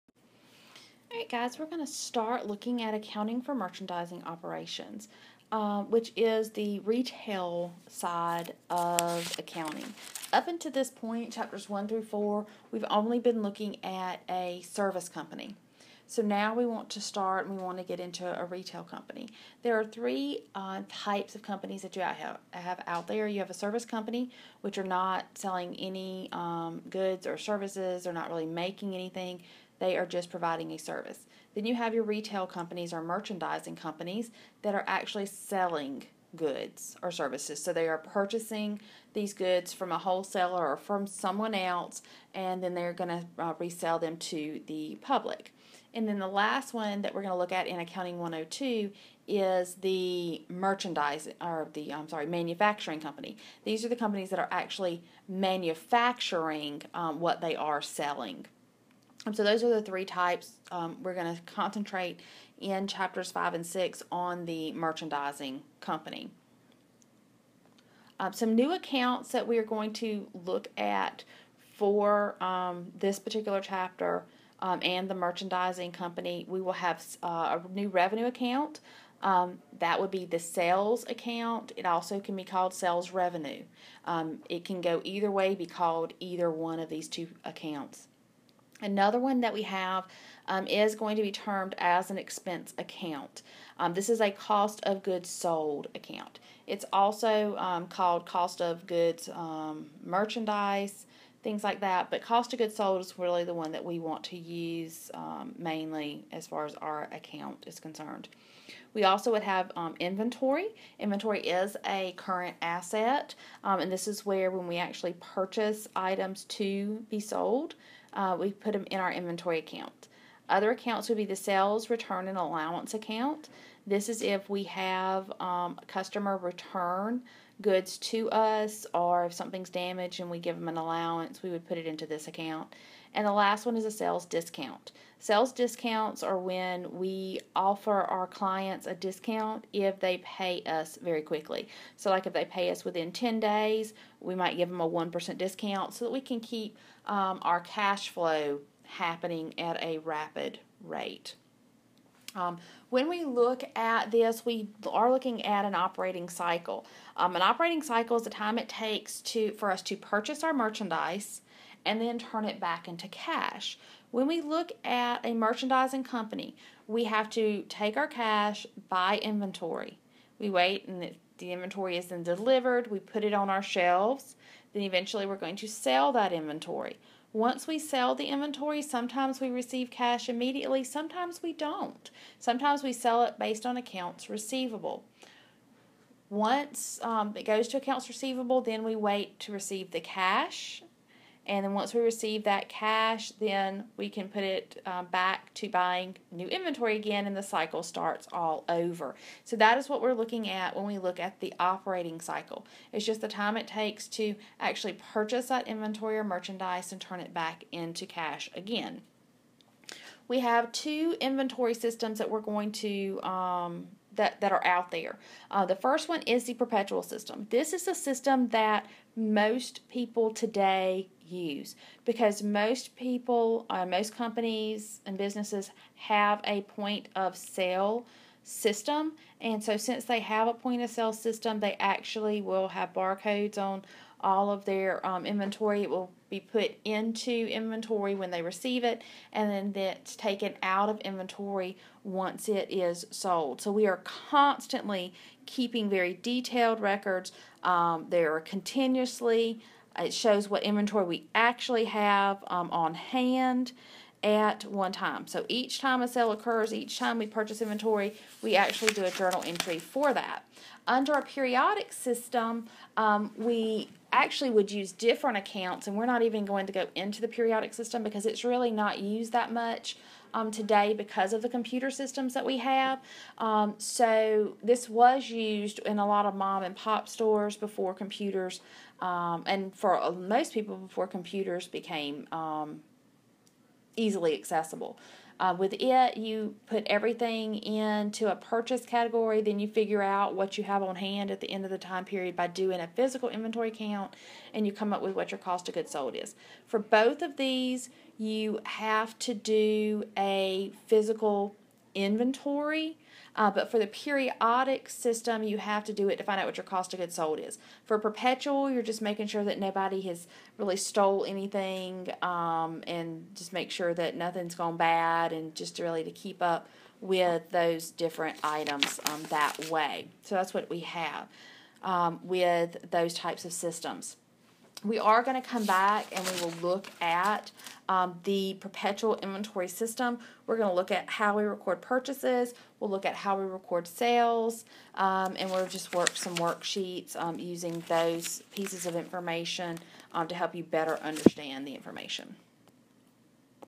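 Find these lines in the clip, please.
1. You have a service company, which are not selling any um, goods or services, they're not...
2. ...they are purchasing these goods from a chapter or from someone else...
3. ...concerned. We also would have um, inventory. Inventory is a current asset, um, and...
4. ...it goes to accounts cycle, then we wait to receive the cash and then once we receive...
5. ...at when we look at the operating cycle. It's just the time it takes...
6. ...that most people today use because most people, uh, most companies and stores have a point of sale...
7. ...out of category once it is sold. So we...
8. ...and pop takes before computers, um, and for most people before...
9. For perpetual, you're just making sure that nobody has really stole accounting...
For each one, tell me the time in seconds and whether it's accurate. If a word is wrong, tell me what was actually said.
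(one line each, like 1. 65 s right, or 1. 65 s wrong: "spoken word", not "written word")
1. 23 s right
2. 37 s wrong: "wholesaler", not "chapter"
3. 107 s right
4. 187 s wrong: "receivable", not "cycle"
5. 200 s right
6. 218 s wrong: "businesses", not "stores"
7. 240 s wrong: "inventory", not "category"
8. 276 s wrong: "stores", not "takes"
9. 307 s wrong: "anything", not "accounting".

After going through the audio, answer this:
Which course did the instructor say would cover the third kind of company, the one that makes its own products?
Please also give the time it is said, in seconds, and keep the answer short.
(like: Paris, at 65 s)
Accounting 102, at 47 s.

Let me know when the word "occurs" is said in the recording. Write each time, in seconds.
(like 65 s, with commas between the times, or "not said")
256 s.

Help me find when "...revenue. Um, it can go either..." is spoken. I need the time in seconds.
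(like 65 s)
83 s.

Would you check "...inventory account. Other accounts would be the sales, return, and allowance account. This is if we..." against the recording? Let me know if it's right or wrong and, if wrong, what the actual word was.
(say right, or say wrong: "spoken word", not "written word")
right.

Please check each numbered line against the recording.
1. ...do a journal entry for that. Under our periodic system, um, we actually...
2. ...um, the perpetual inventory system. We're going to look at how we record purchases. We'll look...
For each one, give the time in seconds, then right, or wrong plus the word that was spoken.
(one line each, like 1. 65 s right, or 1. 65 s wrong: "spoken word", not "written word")
1. 258 s right
2. 327 s right.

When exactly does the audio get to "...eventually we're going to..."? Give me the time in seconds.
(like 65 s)
174 s.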